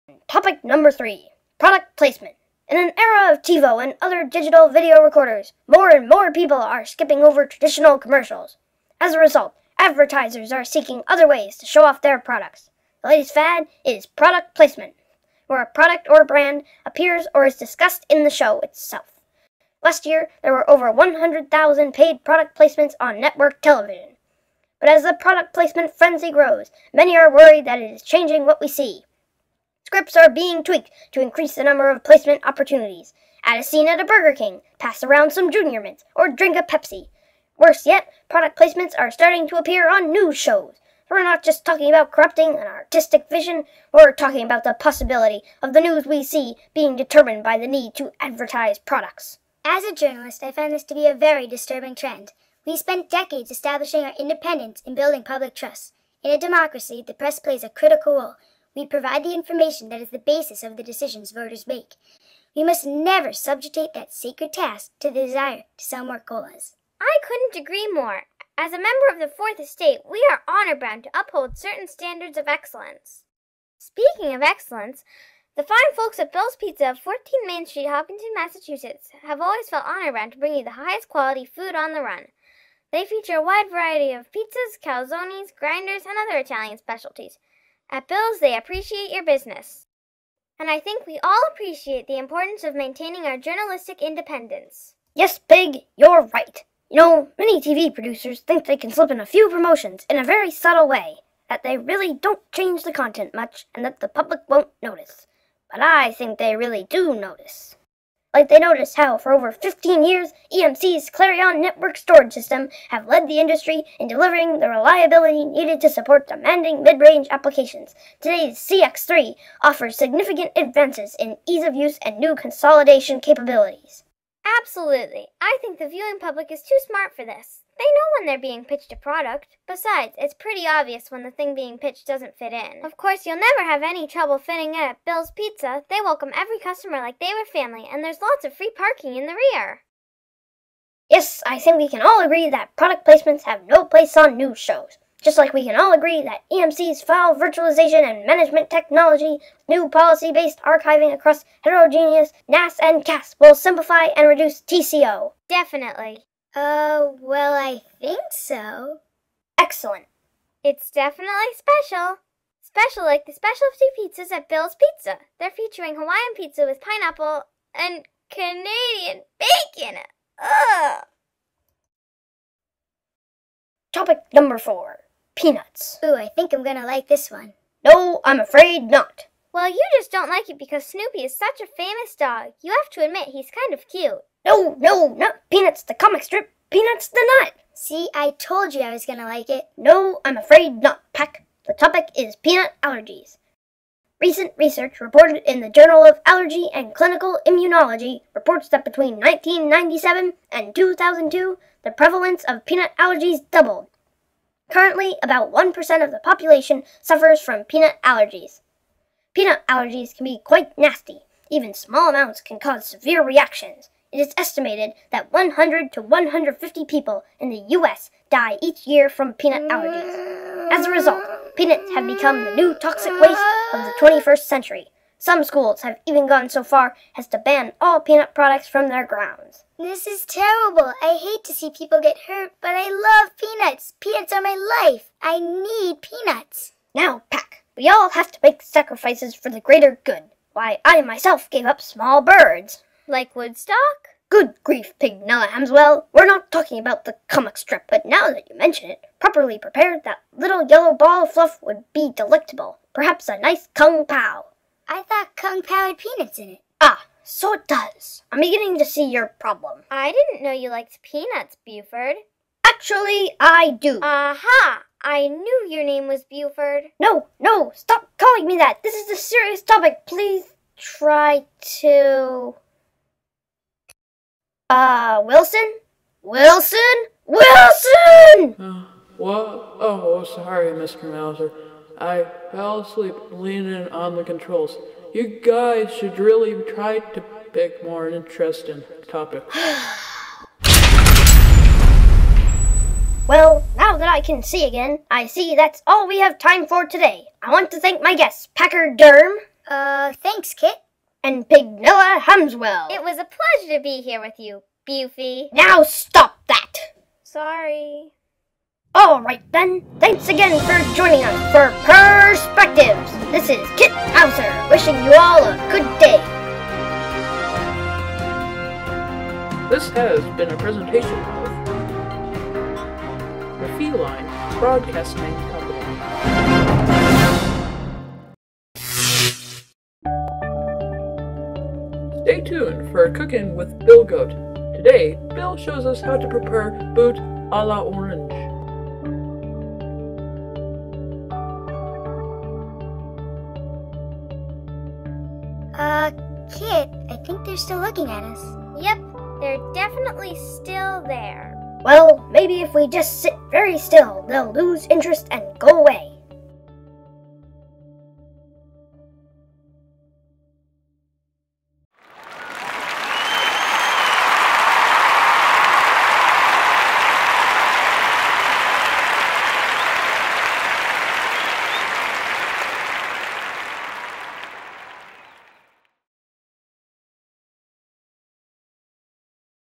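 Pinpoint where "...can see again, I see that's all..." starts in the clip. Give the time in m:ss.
4:54.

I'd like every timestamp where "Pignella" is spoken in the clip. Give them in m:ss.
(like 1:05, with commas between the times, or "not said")
4:05, 5:01.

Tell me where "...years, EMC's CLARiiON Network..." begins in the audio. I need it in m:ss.
1:50.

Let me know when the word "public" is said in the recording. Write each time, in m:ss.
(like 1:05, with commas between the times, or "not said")
0:55, 1:44, 2:06.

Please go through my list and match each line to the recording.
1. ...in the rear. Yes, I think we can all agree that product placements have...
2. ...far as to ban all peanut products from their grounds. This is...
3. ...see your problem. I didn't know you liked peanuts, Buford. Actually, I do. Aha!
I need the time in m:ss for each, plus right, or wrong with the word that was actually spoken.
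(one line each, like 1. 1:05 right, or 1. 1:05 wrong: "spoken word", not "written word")
1. 2:19 right
2. 3:46 right
3. 4:18 right.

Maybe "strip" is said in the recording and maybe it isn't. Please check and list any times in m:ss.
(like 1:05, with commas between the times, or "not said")
3:06, 4:07.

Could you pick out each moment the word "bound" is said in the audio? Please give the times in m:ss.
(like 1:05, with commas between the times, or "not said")
1:10, 1:20.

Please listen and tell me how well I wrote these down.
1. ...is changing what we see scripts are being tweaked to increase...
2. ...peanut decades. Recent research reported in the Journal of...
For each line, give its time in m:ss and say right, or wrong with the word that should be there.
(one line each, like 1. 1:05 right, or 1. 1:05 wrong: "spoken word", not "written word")
1. 0:27 right
2. 3:12 wrong: "allergies", not "decades".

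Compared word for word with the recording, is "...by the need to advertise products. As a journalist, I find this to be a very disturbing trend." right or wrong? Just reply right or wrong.
right.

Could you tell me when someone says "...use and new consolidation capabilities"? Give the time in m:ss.
2:01.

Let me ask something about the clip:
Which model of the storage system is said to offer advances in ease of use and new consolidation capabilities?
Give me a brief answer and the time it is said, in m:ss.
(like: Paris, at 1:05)
CX3, at 1:58.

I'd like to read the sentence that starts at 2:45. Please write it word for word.
They're featuring Hawaiian pizza with pineapple and Canadian bacon.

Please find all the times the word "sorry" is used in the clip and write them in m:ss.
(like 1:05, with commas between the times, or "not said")
4:40, 5:07.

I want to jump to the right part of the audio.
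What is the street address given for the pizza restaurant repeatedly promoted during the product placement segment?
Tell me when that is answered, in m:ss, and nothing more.
1:16.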